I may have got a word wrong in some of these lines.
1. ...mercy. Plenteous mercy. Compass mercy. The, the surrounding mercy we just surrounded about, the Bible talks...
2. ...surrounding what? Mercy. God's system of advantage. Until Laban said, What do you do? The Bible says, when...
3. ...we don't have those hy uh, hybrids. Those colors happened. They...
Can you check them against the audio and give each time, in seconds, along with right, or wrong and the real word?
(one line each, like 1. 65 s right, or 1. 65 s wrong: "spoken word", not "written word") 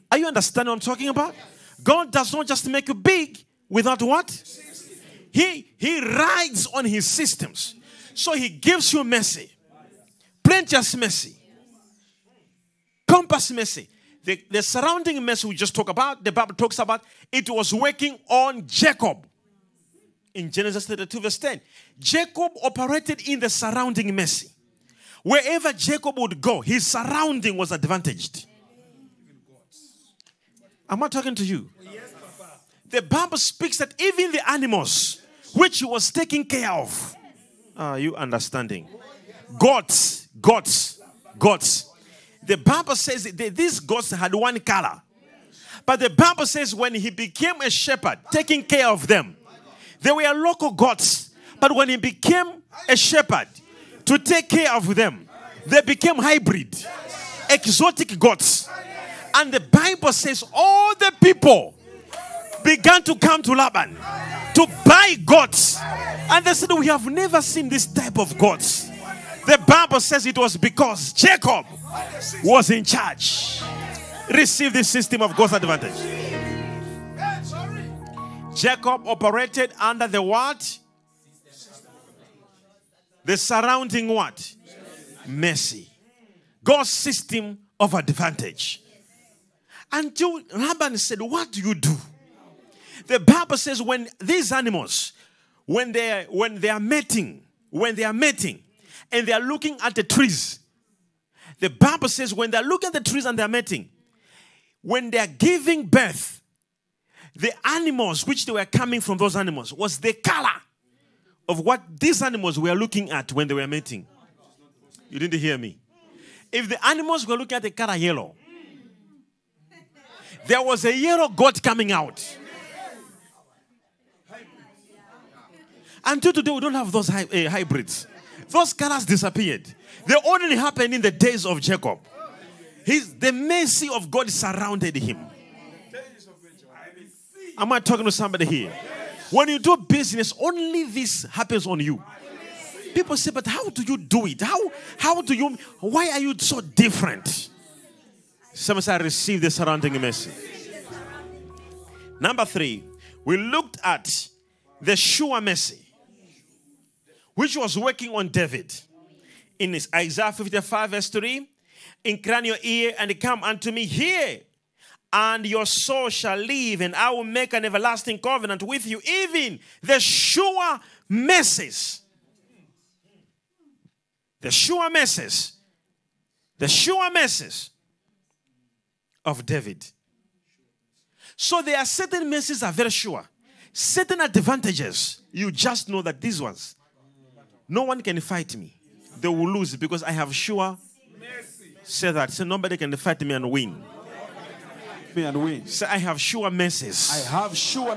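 1. 9 s wrong: "talked", not "surrounded"
2. 83 s right
3. 126 s wrong: "disappeared", not "happened".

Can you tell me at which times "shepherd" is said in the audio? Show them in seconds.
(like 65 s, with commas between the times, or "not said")
47 s, 52 s.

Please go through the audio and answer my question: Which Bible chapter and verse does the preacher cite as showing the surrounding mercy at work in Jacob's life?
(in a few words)
Genesis 32:10.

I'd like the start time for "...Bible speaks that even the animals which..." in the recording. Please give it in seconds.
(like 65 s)
33 s.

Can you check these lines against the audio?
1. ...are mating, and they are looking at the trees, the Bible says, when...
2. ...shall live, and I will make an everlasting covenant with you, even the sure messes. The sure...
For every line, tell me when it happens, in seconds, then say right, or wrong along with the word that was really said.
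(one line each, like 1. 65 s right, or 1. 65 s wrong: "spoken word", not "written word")
1. 98 s right
2. 166 s right.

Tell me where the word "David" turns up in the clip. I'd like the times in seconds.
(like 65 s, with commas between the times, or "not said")
158 s, 179 s.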